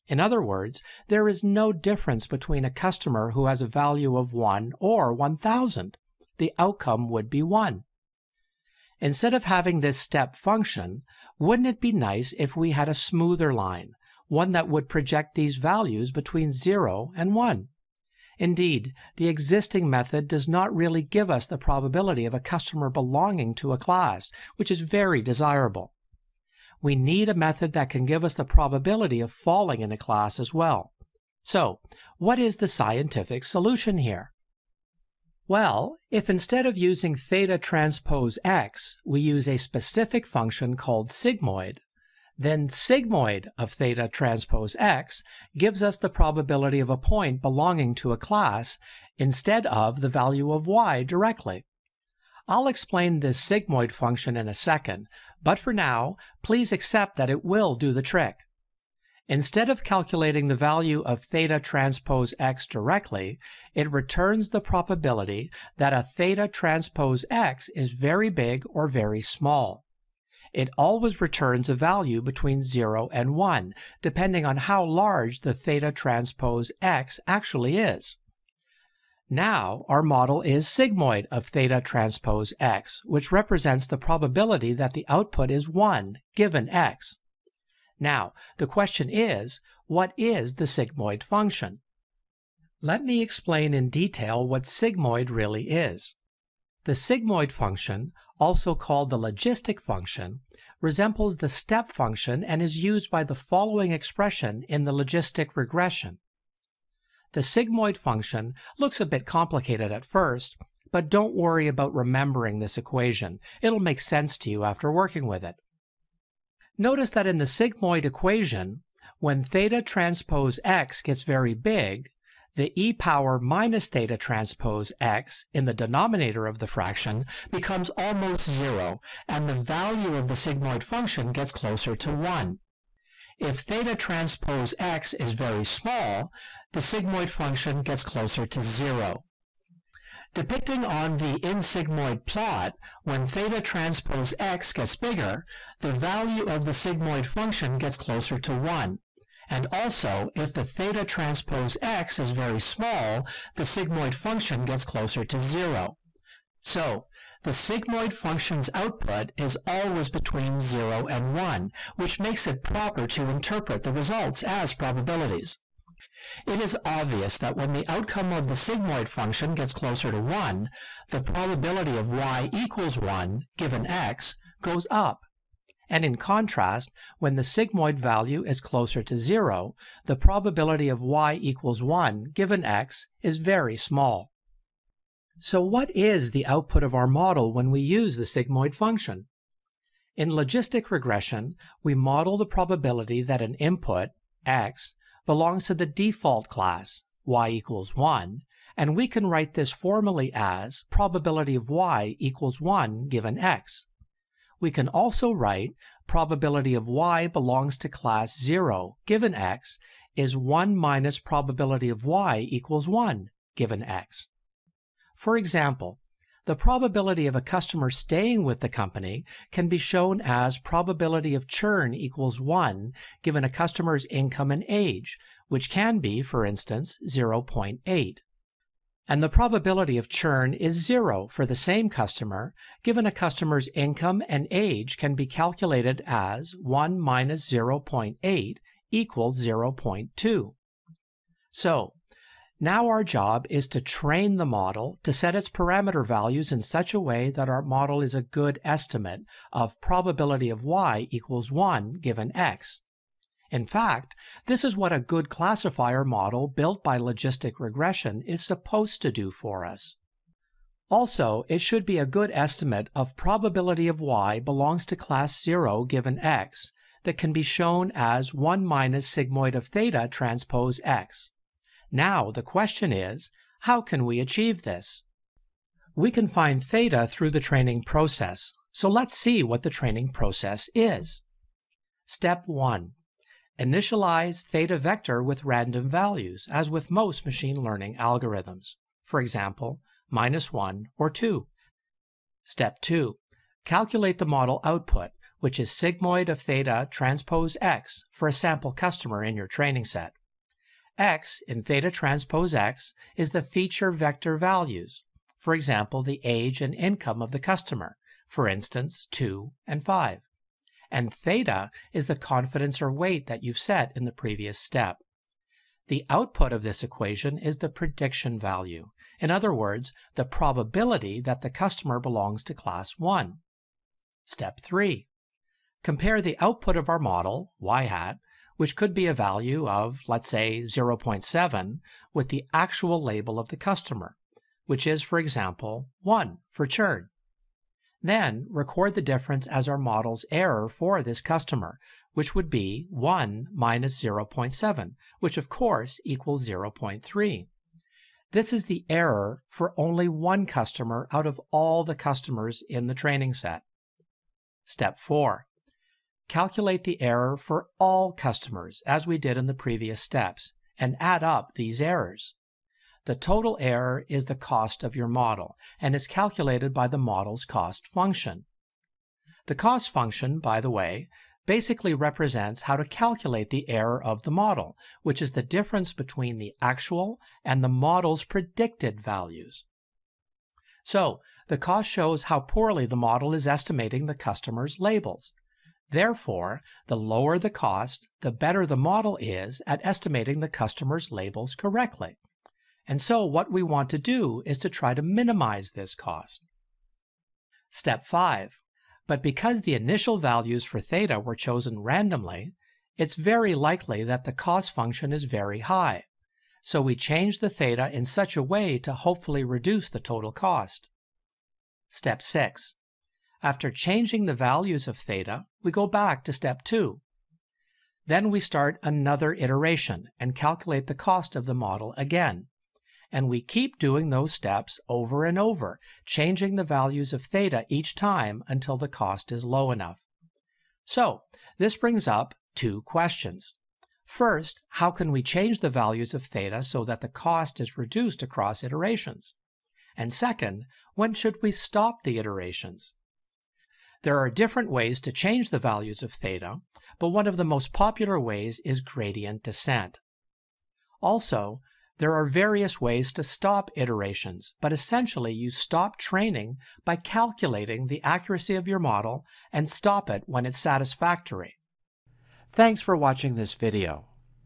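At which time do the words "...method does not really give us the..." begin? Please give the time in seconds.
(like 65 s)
19 s.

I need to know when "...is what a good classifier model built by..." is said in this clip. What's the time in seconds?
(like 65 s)
254 s.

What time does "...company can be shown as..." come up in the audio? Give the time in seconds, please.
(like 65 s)
218 s.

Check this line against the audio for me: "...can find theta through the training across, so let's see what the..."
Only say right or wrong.
wrong.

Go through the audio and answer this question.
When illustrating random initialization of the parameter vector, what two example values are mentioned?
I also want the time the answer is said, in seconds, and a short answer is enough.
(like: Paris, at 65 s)
-1 or 2, at 290 s.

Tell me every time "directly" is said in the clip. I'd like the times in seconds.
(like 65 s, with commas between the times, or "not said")
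51 s, 62 s.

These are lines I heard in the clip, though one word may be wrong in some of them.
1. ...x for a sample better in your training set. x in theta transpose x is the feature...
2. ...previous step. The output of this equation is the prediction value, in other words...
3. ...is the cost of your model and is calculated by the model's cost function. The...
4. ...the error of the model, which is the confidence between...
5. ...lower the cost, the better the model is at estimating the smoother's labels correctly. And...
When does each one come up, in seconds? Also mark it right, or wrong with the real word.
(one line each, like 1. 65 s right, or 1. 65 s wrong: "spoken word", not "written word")
1. 297 s wrong: "customer", not "better"
2. 314 s right
3. 364 s right
4. 373 s wrong: "difference", not "confidence"
5. 386 s wrong: "customer", not "smoother".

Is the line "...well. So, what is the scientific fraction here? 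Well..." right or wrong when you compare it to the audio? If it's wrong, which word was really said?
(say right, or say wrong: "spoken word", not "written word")
wrong: "solution", not "fraction".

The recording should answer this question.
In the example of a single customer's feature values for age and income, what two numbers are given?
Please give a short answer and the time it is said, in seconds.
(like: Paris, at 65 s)
2 and 5, at 309 s.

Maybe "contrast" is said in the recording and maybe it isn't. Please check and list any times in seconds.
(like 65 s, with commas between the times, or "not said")
176 s.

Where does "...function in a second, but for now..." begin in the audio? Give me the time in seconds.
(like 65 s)
53 s.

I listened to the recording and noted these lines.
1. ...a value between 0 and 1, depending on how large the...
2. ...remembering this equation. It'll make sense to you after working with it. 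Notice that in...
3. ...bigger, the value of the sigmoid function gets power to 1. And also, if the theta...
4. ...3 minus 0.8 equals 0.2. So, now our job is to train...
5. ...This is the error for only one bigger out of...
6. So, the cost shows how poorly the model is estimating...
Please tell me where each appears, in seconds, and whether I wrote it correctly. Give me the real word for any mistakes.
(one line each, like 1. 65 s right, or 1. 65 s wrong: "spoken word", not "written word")
1. 71 s right
2. 111 s right
3. 144 s wrong: "closer", not "power"
4. 236 s wrong: "1", not "3"
5. 348 s wrong: "customer", not "bigger"
6. 380 s right.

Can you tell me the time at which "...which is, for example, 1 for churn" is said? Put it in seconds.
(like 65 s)
334 s.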